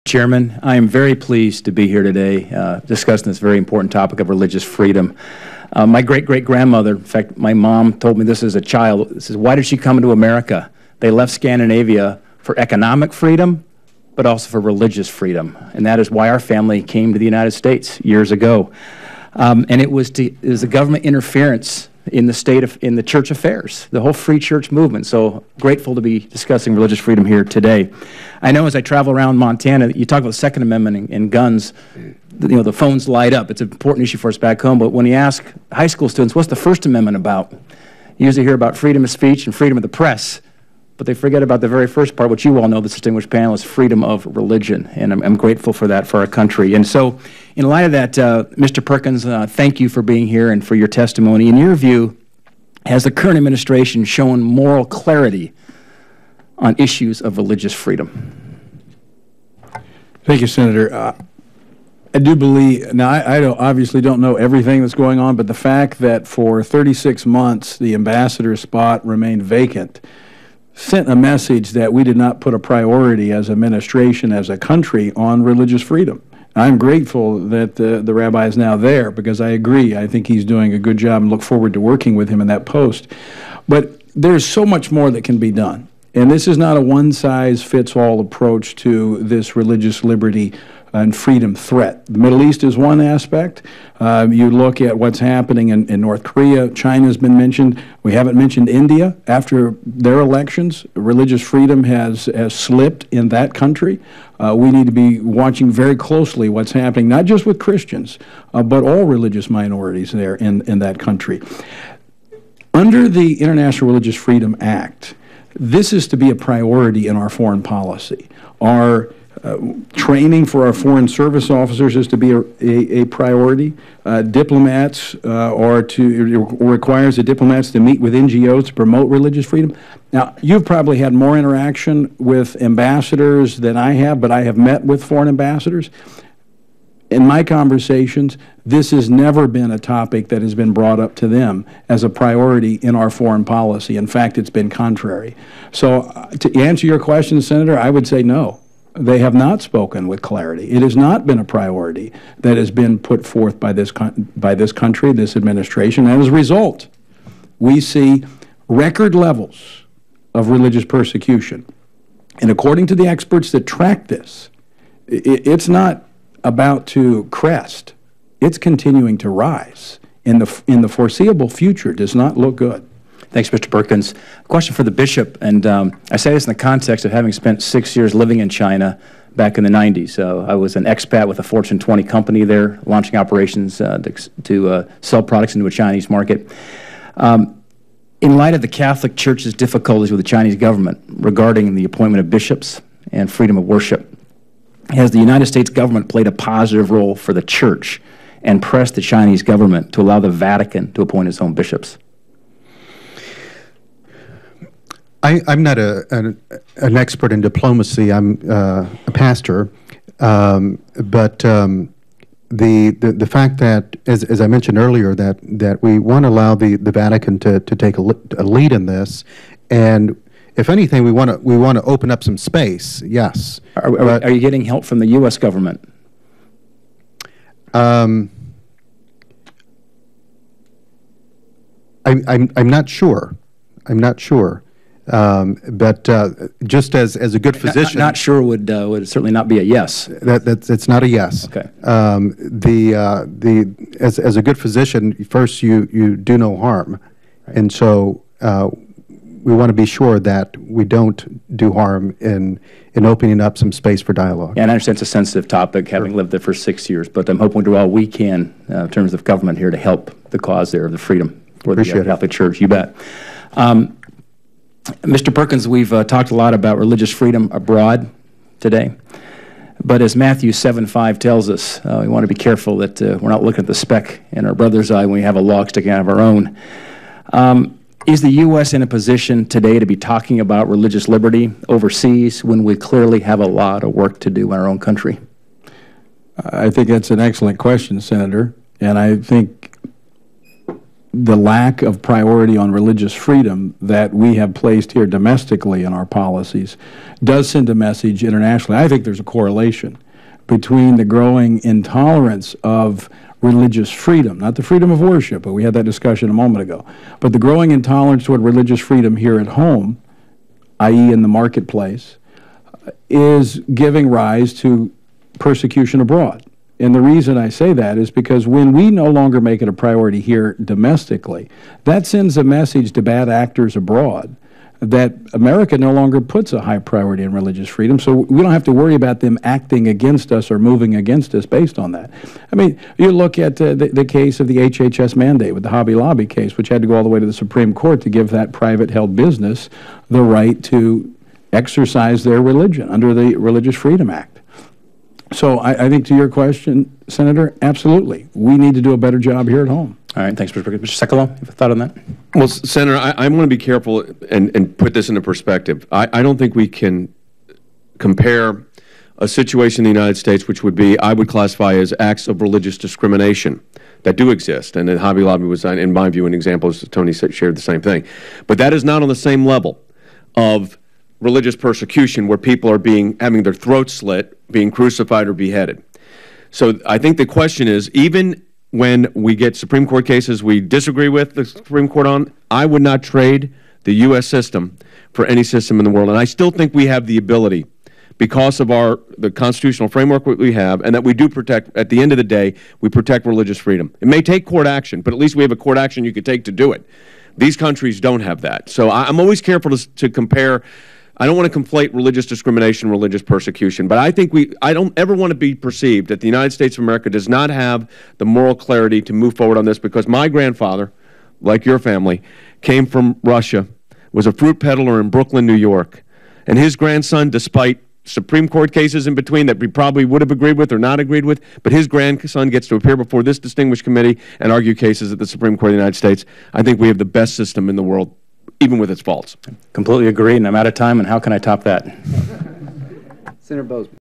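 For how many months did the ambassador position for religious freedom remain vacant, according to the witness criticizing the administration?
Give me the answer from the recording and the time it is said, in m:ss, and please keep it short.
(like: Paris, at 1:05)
36, at 1:06.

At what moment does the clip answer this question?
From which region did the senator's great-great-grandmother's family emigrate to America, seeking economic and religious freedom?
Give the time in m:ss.
0:11.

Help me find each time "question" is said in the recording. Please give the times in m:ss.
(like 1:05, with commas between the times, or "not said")
2:26, 2:54, 4:47, 5:46, 6:17.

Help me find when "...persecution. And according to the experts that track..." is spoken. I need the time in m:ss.
2:40.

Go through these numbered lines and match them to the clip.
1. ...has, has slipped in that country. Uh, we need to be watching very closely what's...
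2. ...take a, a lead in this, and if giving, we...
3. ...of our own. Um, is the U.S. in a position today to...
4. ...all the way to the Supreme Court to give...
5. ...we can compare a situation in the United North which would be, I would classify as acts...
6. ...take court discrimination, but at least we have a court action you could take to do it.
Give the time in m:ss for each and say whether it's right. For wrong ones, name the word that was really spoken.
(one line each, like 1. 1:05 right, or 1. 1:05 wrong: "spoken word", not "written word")
1. 1:41 right
2. 3:37 wrong: "anything", not "giving"
3. 4:36 right
4. 5:36 right
5. 5:56 wrong: "States", not "North"
6. 6:34 wrong: "action", not "discrimination".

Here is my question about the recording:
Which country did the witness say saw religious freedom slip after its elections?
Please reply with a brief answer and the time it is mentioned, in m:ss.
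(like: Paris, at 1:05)
India, at 1:38.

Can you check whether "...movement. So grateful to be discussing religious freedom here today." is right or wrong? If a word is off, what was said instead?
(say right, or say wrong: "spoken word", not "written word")
right.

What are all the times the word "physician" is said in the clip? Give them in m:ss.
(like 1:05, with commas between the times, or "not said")
3:57, 4:04.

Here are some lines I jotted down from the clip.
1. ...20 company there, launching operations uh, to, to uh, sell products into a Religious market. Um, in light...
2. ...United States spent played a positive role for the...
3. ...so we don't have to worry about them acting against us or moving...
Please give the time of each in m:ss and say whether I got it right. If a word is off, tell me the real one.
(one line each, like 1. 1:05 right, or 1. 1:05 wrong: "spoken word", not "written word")
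1. 3:01 wrong: "Chinese", not "Religious"
2. 3:15 wrong: "government", not "spent"
3. 5:27 right.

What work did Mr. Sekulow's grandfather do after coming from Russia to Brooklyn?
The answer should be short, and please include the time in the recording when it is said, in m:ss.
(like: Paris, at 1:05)
fruit peddler, at 6:54.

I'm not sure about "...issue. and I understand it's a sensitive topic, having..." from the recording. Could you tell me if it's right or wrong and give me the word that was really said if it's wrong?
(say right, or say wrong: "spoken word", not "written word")
wrong: "dialogue", not "issue".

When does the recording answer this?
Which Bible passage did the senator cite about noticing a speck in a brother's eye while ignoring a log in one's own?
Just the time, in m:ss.
4:30.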